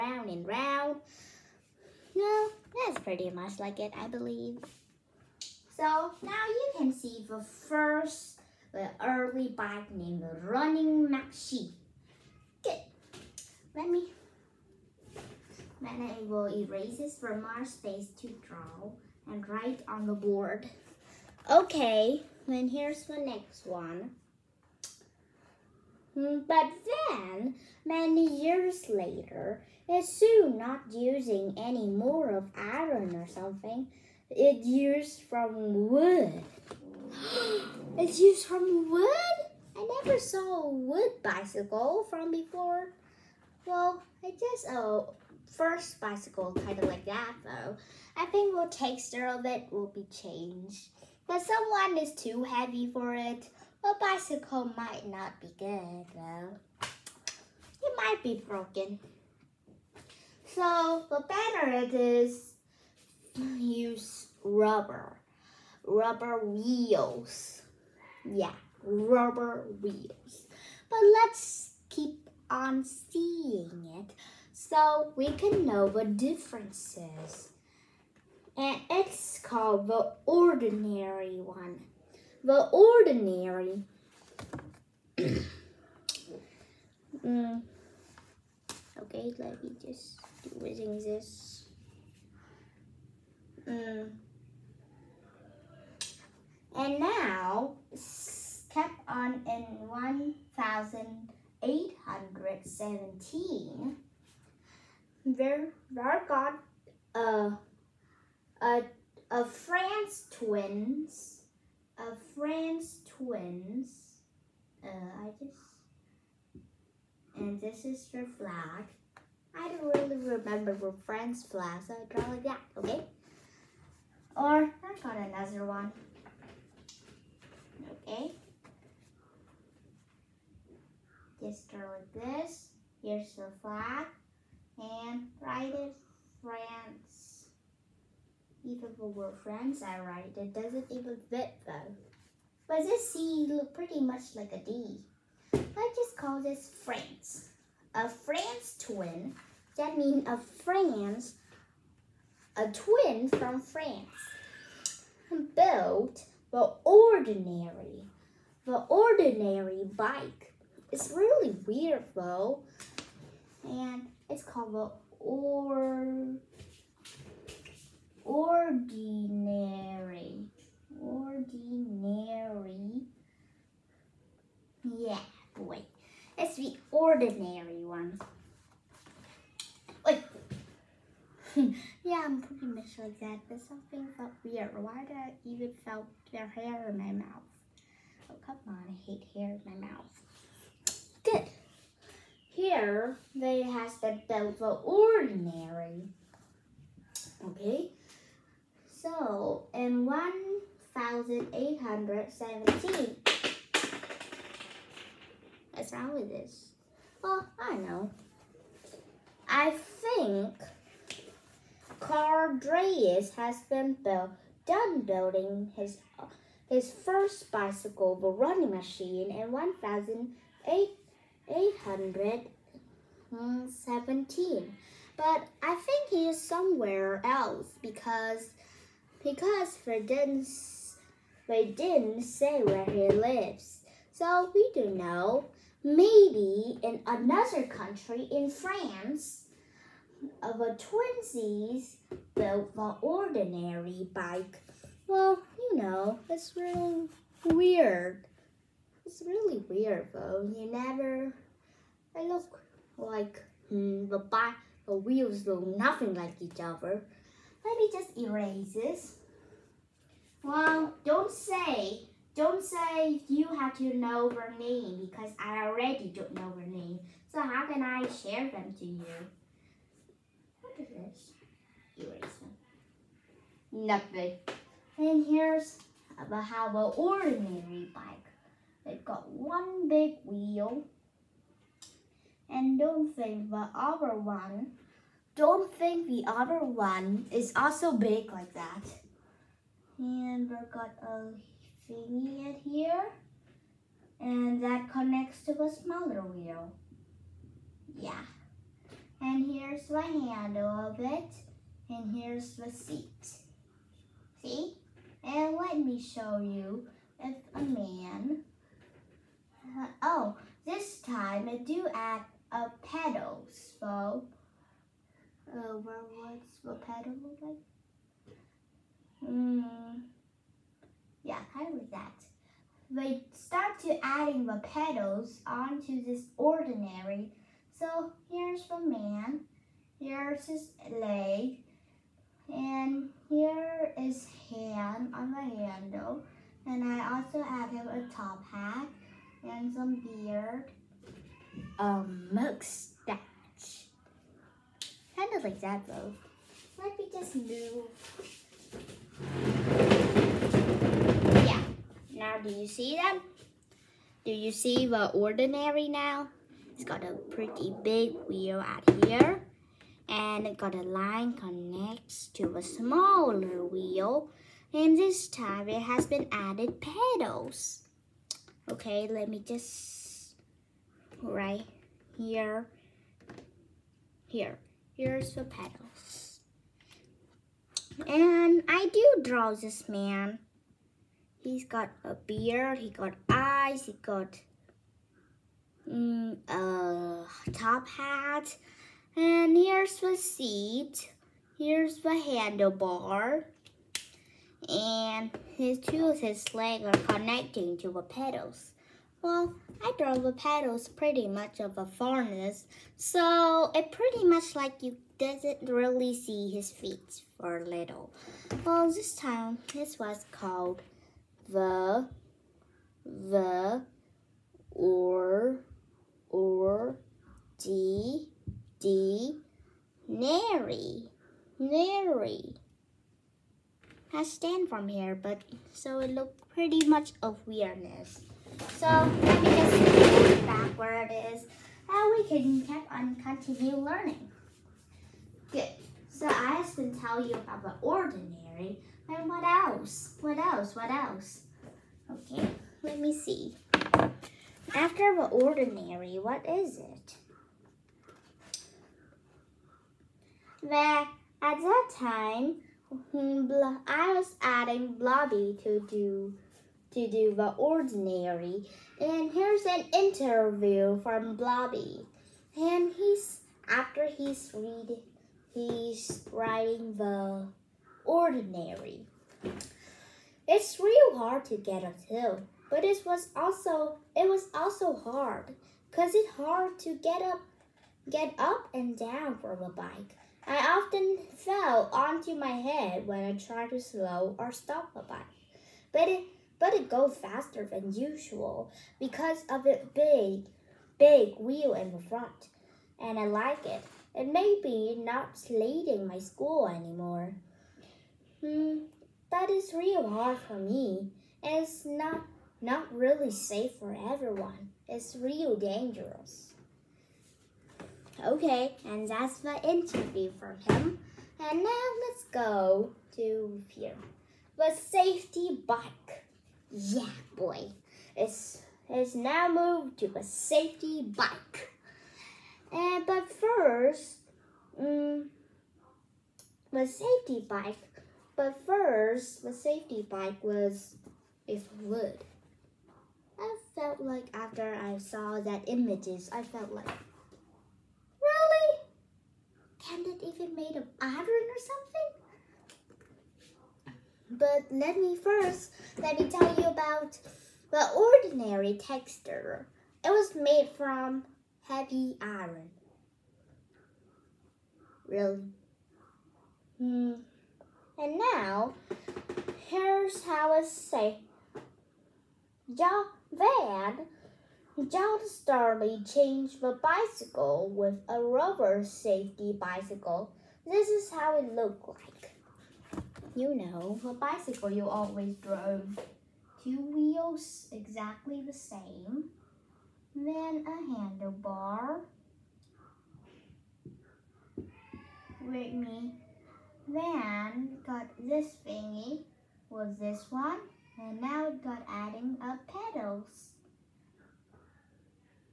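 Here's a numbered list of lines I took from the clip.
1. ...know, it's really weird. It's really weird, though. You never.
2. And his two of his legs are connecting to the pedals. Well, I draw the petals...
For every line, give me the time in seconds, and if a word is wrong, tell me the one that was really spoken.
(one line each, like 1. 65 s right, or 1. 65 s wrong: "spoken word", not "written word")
1. 245 s right
2. 394 s right.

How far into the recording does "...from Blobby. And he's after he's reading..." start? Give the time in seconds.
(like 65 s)
461 s.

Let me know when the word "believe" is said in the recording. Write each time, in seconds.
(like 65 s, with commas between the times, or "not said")
4 s.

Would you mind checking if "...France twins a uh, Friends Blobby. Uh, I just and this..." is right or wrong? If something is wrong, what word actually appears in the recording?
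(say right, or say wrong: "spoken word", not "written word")
wrong: "Twins", not "Blobby".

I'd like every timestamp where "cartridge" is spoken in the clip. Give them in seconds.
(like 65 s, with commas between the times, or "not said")
not said.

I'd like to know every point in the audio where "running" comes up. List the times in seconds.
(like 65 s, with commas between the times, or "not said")
10 s, 218 s.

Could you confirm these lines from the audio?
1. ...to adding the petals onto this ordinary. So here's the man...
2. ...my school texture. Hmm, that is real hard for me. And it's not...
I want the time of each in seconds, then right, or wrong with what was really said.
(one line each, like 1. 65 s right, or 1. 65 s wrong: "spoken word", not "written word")
1. 323 s right
2. 496 s wrong: "anymore", not "texture".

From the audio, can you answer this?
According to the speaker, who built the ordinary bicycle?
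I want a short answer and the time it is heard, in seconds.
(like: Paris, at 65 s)
A France twin, at 147 s.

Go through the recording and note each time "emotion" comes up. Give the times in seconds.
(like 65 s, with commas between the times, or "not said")
not said.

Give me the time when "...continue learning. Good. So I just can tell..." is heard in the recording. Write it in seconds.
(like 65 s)
433 s.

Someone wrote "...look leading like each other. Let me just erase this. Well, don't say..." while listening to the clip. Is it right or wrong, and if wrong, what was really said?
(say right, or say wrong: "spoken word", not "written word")
wrong: "nothing", not "leading".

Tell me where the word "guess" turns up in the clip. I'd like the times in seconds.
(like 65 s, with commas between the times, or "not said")
44 s.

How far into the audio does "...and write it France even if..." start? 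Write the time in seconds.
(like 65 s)
134 s.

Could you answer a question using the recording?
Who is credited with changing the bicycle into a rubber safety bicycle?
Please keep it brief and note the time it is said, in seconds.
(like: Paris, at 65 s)
John Starley, at 564 s.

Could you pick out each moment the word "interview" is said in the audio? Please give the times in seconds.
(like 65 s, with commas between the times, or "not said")
459 s, 509 s.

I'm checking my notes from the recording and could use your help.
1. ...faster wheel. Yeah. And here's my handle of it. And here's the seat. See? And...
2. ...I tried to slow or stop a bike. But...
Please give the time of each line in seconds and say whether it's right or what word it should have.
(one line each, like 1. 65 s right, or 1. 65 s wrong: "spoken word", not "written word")
1. 295 s wrong: "smaller", not "faster"
2. 483 s right.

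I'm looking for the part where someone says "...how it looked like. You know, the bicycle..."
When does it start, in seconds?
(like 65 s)
571 s.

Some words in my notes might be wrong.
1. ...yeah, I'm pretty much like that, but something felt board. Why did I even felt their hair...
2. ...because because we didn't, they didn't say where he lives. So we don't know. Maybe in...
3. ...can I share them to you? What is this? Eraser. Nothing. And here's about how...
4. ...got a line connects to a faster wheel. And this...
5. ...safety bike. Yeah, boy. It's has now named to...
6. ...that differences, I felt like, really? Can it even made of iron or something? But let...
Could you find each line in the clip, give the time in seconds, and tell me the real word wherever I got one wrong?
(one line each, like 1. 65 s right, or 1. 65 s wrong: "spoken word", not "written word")
1. 182 s wrong: "weird", not "board"
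2. 227 s right
3. 267 s right
4. 360 s wrong: "smaller", not "faster"
5. 514 s wrong: "moved", not "named"
6. 535 s wrong: "images", not "differences".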